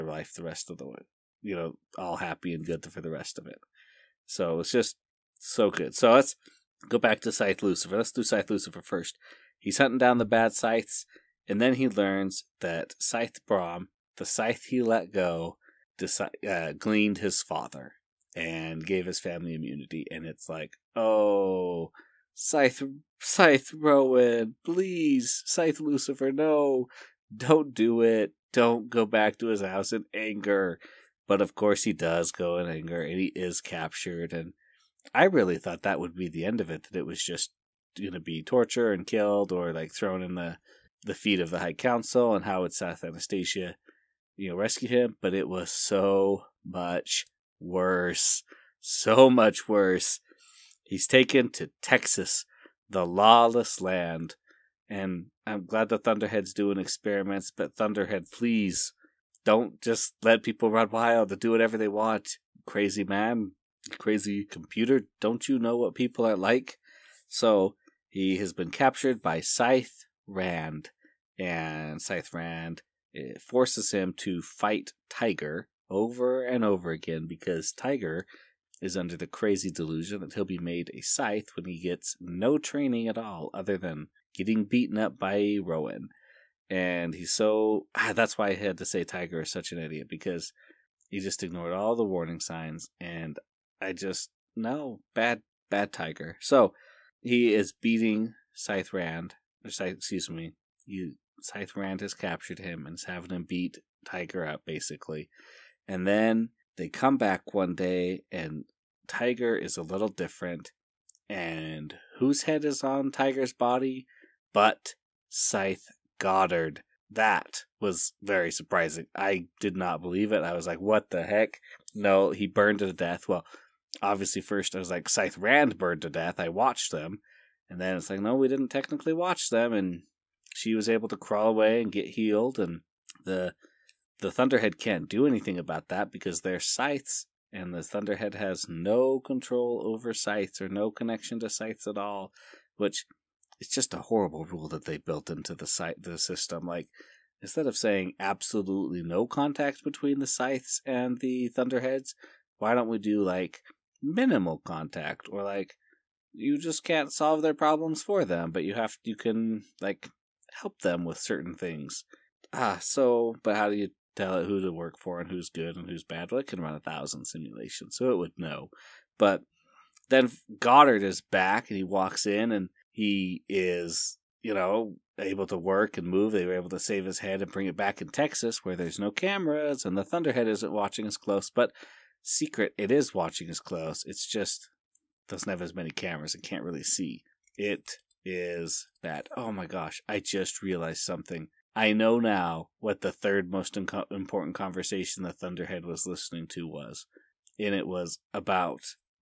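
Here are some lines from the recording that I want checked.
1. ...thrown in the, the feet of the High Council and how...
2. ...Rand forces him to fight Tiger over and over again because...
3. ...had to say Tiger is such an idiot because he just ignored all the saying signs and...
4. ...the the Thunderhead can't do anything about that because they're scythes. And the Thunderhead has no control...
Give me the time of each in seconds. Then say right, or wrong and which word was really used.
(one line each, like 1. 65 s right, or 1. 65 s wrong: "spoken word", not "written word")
1. 39 s right
2. 72 s right
3. 88 s wrong: "warning", not "saying"
4. 133 s right.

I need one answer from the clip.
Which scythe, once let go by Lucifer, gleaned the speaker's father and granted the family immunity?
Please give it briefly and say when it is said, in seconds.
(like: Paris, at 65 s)
Scythe Brom, at 12 s.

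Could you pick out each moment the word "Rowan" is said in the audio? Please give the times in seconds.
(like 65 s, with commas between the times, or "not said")
23 s, 85 s.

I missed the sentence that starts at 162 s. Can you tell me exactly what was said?
Ah, so but how do you tell it who to work for and who's good and who's bad?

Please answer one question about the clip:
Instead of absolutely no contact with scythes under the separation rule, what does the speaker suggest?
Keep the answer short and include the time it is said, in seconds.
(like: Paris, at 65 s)
minimal contact, at 154 s.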